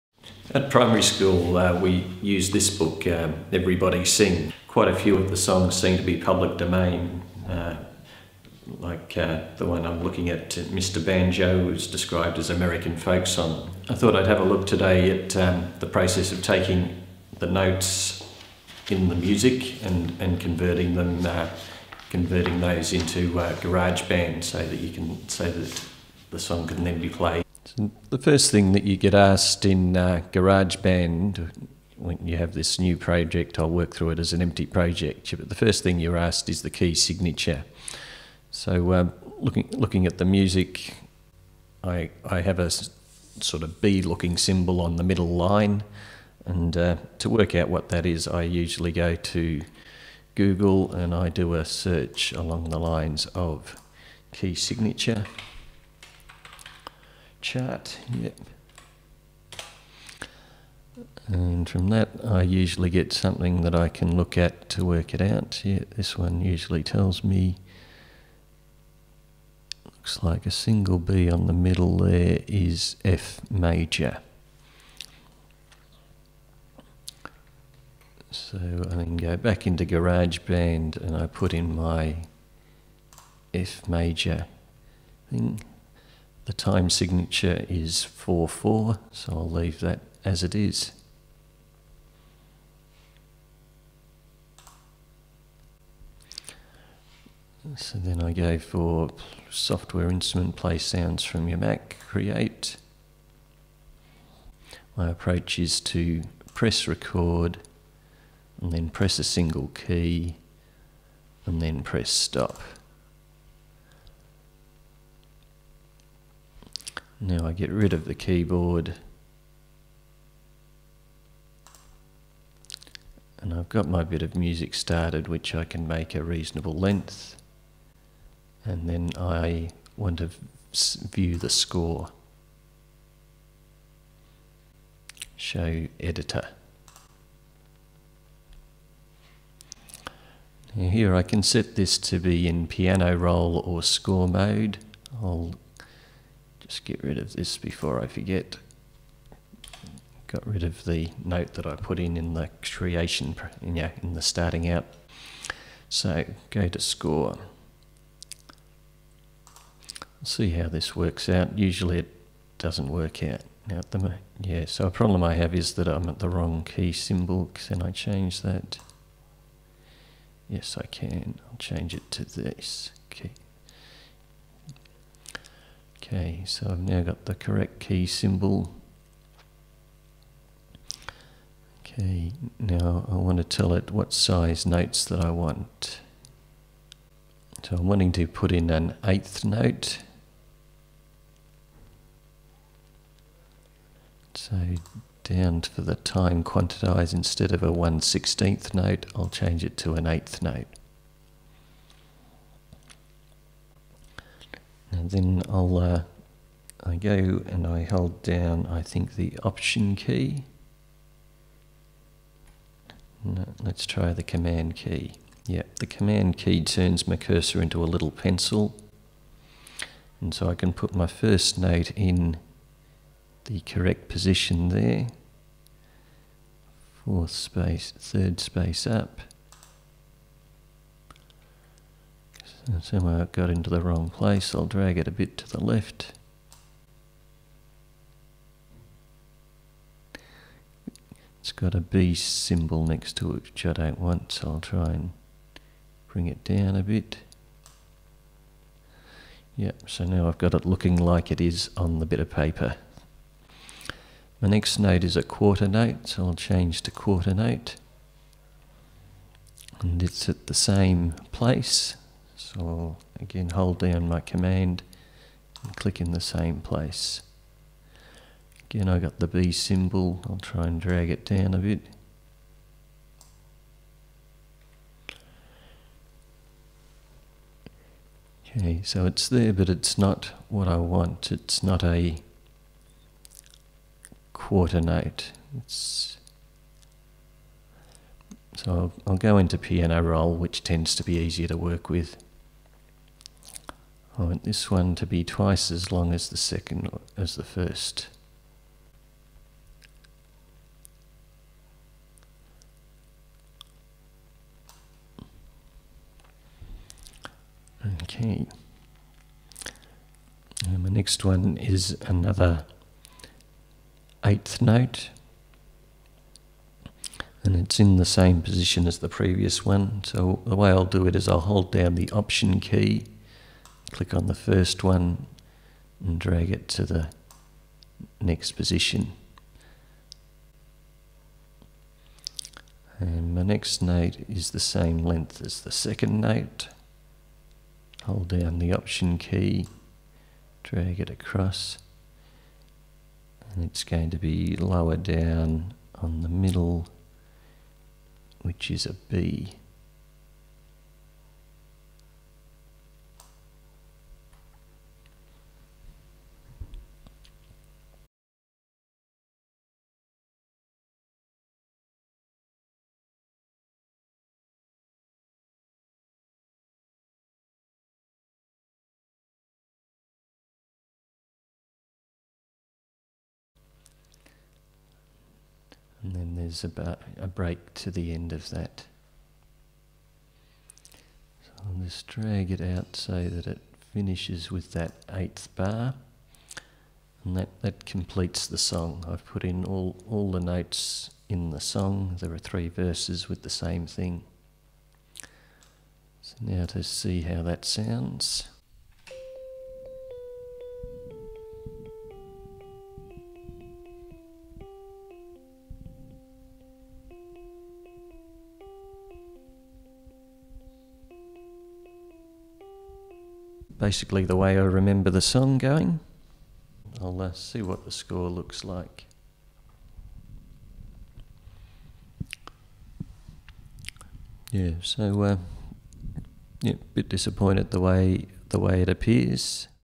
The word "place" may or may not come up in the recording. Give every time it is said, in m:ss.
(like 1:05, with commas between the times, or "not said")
3:54, 4:21, 4:26.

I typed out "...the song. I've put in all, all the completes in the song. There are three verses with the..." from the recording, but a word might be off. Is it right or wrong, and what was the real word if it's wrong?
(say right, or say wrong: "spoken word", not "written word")
wrong: "notes", not "completes".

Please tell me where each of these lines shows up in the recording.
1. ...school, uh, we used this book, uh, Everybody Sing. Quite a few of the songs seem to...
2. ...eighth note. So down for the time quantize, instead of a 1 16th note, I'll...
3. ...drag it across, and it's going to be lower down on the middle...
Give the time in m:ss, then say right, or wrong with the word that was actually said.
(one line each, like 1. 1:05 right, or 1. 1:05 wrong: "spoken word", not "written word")
1. 0:01 right
2. 3:09 right
3. 5:40 right.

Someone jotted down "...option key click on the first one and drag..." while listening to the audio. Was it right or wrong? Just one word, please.
right.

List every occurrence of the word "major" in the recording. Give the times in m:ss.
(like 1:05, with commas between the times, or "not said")
1:13, 1:23.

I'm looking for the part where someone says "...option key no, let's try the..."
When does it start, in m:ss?
3:29.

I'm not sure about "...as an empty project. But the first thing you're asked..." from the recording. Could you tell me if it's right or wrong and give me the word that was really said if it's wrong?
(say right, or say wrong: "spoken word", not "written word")
right.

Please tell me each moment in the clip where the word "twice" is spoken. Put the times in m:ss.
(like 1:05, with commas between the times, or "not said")
4:55.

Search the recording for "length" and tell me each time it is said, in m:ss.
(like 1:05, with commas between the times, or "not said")
2:06, 5:34.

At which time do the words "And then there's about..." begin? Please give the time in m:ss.
6:16.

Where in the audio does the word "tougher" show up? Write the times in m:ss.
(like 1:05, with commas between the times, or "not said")
not said.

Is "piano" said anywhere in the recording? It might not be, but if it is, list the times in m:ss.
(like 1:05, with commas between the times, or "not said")
2:22, 4:49.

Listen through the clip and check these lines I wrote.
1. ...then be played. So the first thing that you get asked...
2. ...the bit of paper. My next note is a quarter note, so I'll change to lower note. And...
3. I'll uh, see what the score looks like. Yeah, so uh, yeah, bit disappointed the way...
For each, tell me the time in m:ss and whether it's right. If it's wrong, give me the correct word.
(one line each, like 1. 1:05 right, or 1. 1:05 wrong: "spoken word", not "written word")
1. 0:26 right
2. 4:11 wrong: "quarter", not "lower"
3. 6:57 right.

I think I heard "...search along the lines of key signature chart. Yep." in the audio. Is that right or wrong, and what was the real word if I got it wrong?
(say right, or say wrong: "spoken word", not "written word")
right.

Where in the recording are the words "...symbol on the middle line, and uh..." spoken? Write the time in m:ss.
0:44.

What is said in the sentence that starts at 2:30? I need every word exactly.
Got rid of the note that I put in in the creation, yeah, in the starting out.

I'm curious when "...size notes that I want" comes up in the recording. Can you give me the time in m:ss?
3:04.